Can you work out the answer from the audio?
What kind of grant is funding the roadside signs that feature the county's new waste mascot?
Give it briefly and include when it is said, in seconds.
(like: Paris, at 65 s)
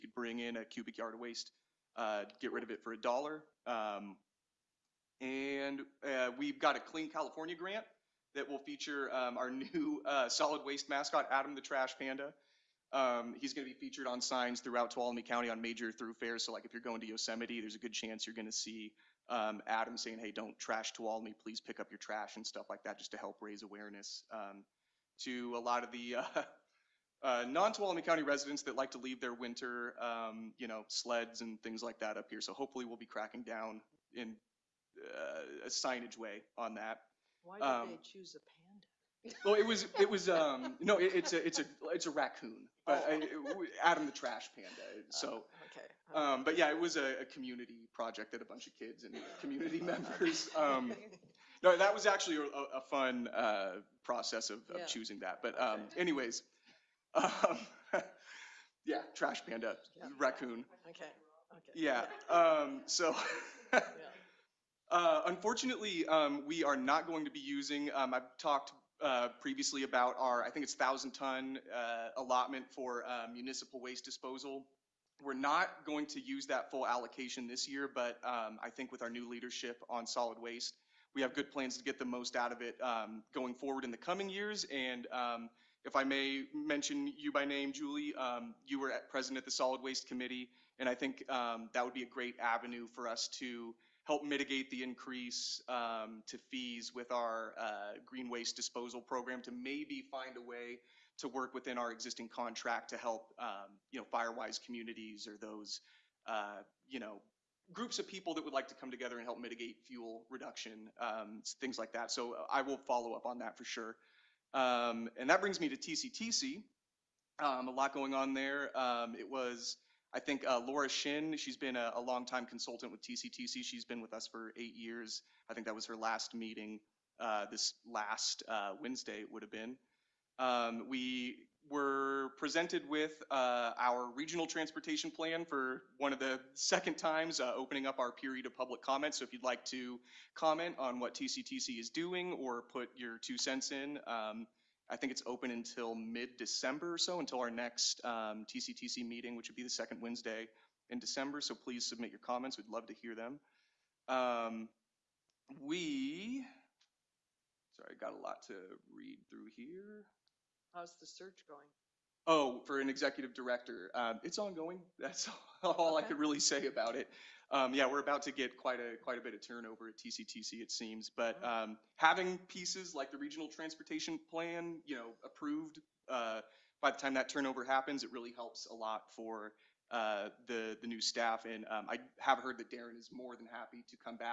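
Clean California, at 6 s.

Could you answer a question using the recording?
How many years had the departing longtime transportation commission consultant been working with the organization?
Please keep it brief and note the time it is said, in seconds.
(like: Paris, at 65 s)
8, at 124 s.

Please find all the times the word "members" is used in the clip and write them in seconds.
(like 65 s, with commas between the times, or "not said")
49 s.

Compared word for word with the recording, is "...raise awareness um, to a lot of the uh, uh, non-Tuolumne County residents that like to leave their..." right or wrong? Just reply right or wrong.
right.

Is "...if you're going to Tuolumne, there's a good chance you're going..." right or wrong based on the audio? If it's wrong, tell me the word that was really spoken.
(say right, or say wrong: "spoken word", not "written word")
wrong: "Yosemite", not "Tuolumne".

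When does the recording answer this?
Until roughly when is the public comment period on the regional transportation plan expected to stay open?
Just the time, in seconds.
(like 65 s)
145 s.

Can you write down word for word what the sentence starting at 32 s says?
So hopefully we'll be cracking down in uh, a signage way on that.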